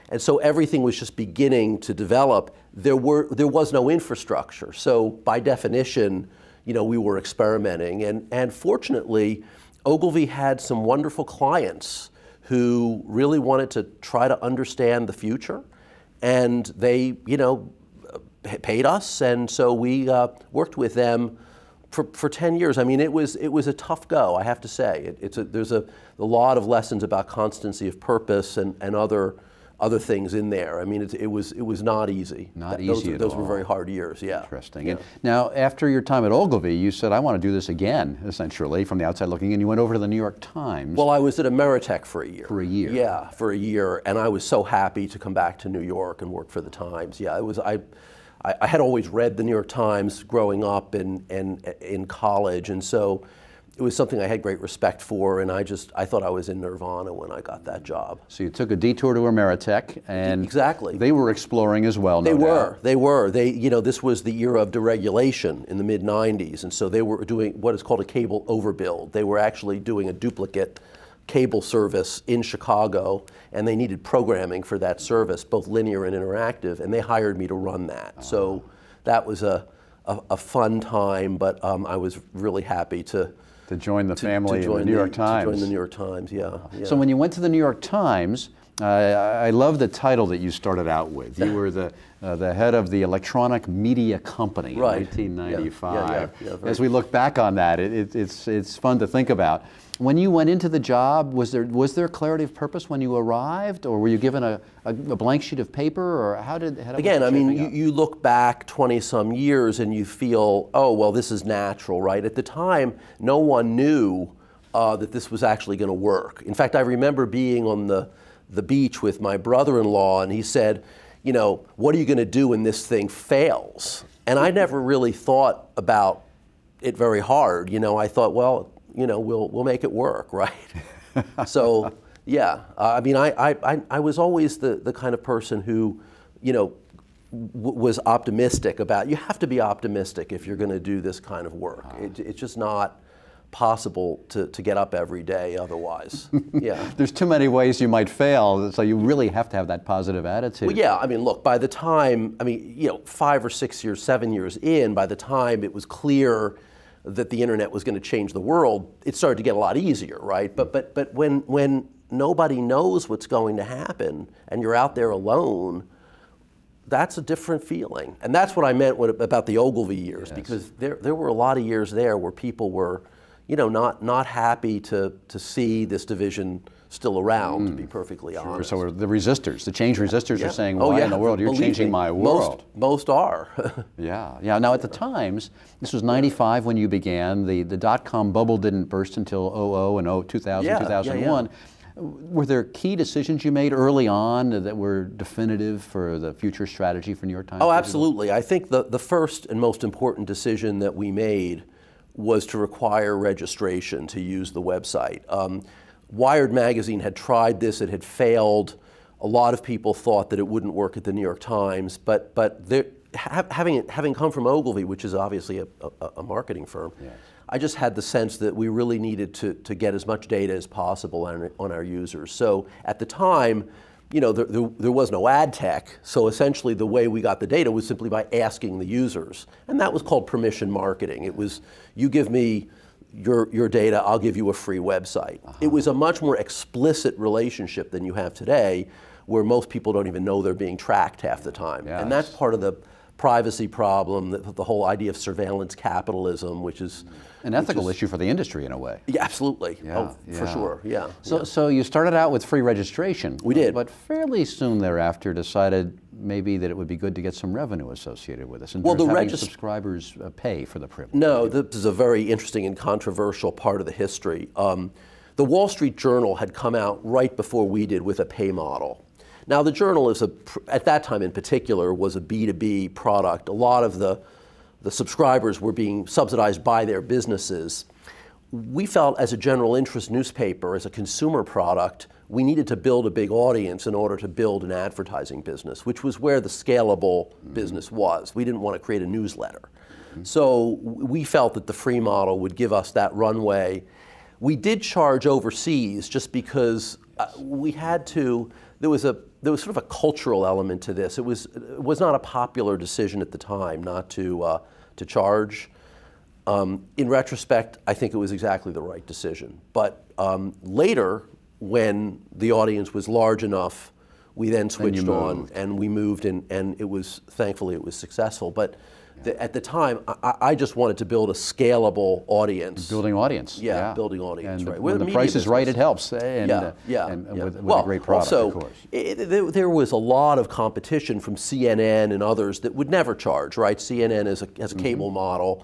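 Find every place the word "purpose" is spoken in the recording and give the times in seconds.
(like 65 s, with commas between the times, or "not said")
27 s, 102 s.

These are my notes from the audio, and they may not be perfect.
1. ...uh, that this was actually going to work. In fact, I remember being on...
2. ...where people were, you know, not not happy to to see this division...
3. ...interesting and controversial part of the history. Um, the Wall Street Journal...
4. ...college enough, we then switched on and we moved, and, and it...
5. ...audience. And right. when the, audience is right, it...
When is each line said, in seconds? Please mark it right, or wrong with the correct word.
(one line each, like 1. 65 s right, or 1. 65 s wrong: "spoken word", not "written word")
1. 114 s right
2. 172 s right
3. 262 s right
4. 313 s wrong: "large", not "college"
5. 324 s wrong: "price", not "audience".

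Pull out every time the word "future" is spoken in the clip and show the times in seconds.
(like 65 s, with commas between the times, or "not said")
15 s, 196 s.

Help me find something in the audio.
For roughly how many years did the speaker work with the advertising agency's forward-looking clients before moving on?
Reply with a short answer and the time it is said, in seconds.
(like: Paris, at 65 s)
10 years, at 22 s.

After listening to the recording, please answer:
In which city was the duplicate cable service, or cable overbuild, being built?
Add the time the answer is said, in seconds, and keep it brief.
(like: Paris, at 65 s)
Chicago, at 72 s.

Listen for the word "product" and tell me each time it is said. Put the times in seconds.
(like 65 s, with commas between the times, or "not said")
272 s, 281 s, 328 s.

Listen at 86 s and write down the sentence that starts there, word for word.
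So when you went to the New York Times, uh, I love the title that you started out with.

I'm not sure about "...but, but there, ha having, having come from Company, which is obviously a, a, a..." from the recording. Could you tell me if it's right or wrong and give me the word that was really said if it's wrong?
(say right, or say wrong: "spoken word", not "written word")
wrong: "Ogilvy", not "Company".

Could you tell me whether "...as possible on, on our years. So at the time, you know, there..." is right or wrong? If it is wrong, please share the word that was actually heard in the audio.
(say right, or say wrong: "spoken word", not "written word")
wrong: "users", not "years".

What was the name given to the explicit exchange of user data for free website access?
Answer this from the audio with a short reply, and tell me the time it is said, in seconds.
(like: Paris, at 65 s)
permission marketing, at 230 s.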